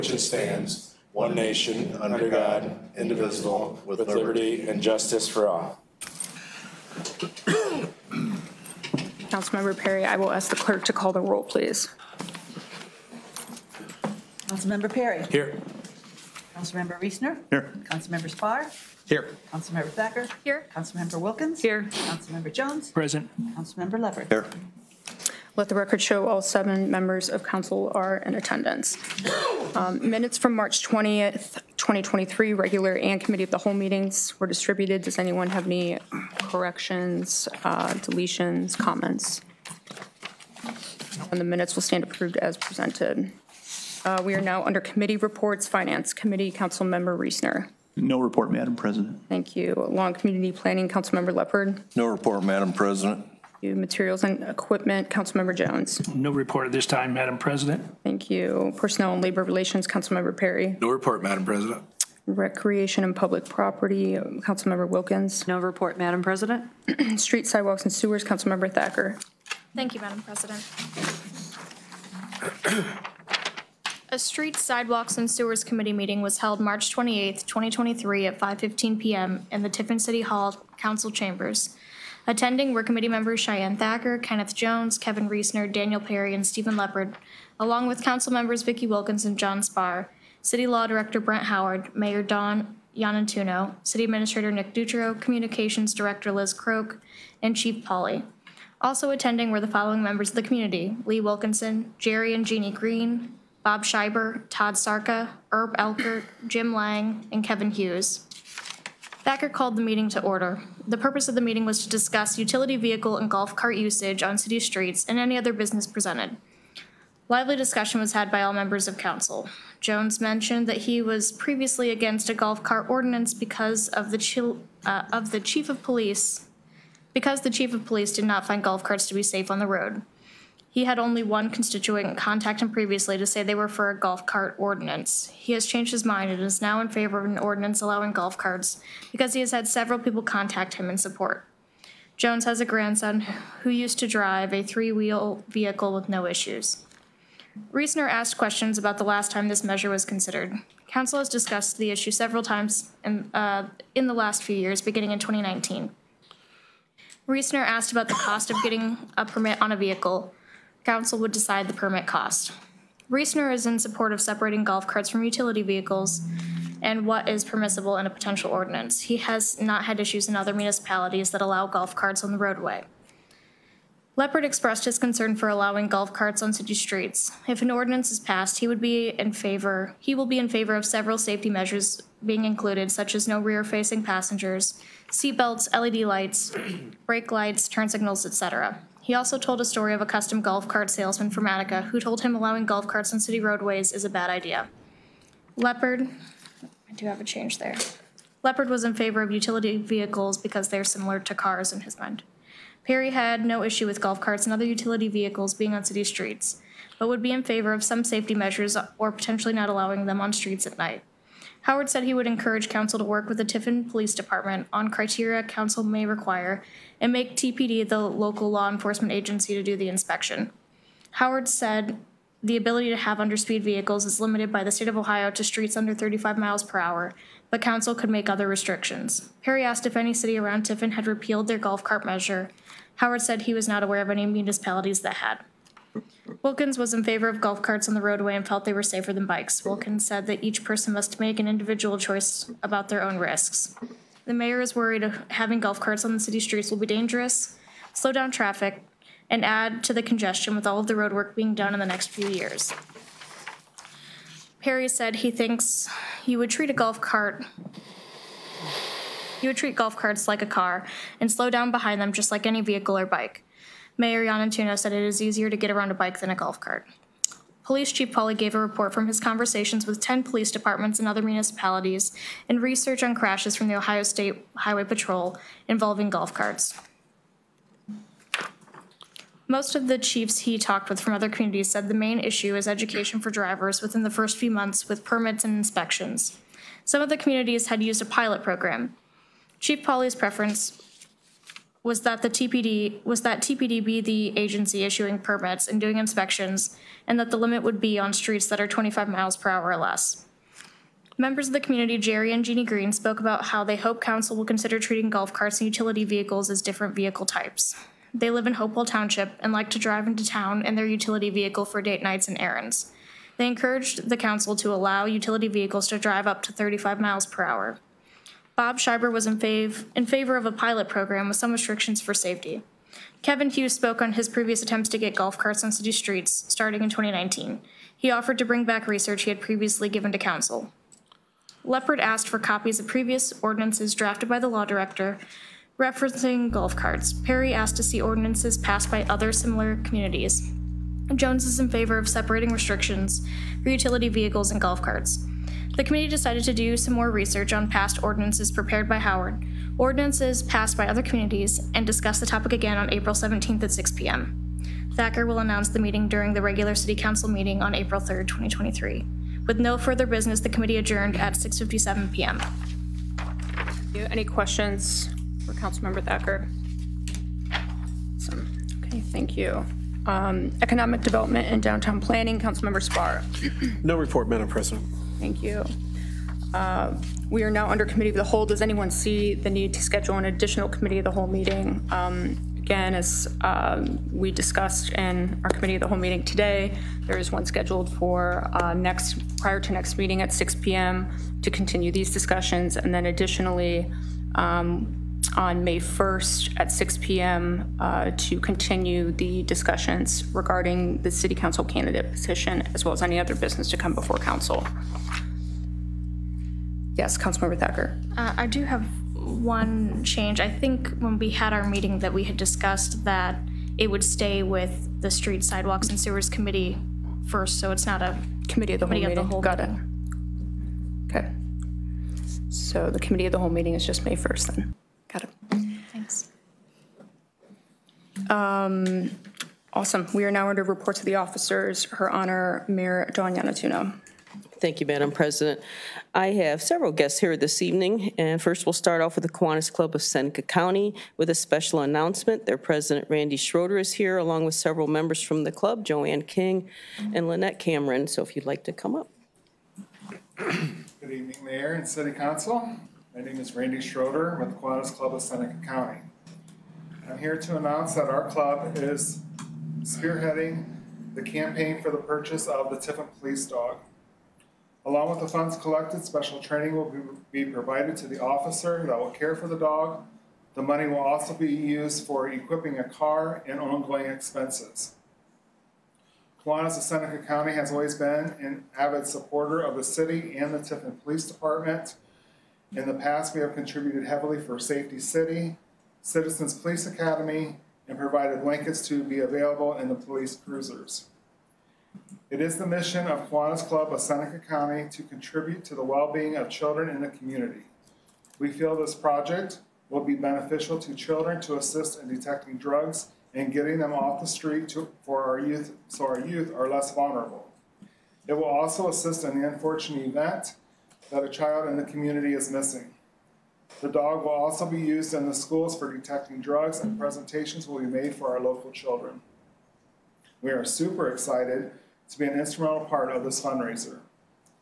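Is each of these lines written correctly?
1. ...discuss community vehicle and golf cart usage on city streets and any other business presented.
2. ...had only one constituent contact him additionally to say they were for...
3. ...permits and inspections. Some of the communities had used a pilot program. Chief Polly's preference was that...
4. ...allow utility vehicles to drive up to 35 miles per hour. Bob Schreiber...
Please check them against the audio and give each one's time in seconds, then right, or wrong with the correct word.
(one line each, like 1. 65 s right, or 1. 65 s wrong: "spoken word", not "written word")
1. 111 s wrong: "utility", not "community"
2. 130 s wrong: "previously", not "additionally"
3. 285 s right
4. 314 s right.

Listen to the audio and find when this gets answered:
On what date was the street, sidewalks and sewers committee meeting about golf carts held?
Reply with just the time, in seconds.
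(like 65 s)
76 s.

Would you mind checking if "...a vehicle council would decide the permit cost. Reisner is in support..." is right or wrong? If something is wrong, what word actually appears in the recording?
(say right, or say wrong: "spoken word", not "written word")
right.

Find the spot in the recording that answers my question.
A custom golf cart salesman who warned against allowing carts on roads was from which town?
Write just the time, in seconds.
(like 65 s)
191 s.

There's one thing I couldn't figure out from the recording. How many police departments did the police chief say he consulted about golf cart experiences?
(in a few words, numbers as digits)
10.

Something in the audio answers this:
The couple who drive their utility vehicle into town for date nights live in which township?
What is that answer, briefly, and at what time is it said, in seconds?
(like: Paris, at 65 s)
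Hopewell Township, at 308 s.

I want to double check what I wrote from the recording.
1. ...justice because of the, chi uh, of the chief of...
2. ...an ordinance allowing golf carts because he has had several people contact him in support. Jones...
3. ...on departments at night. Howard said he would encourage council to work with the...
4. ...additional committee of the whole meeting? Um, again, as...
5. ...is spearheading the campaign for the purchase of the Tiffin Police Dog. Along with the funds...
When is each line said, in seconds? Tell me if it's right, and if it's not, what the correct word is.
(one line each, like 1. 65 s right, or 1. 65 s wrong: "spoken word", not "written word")
1. 122 s wrong: "ordinance", not "justice"
2. 137 s right
3. 210 s wrong: "streets", not "departments"
4. 380 s right
5. 458 s right.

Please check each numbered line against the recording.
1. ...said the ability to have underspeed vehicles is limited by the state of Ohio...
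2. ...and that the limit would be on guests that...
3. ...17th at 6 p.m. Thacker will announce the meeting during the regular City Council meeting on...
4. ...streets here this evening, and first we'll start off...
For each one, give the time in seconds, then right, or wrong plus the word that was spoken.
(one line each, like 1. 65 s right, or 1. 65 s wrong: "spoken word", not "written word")
1. 221 s right
2. 297 s wrong: "streets", not "guests"
3. 353 s right
4. 436 s wrong: "guests", not "streets".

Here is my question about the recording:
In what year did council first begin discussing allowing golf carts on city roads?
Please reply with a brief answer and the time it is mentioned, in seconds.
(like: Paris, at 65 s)
2019, at 154 s.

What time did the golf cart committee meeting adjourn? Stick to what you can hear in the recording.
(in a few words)
6:57 p.m.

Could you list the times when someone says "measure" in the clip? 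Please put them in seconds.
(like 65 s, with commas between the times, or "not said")
149 s, 181 s, 208 s, 232 s.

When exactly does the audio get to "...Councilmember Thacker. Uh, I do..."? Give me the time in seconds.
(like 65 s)
407 s.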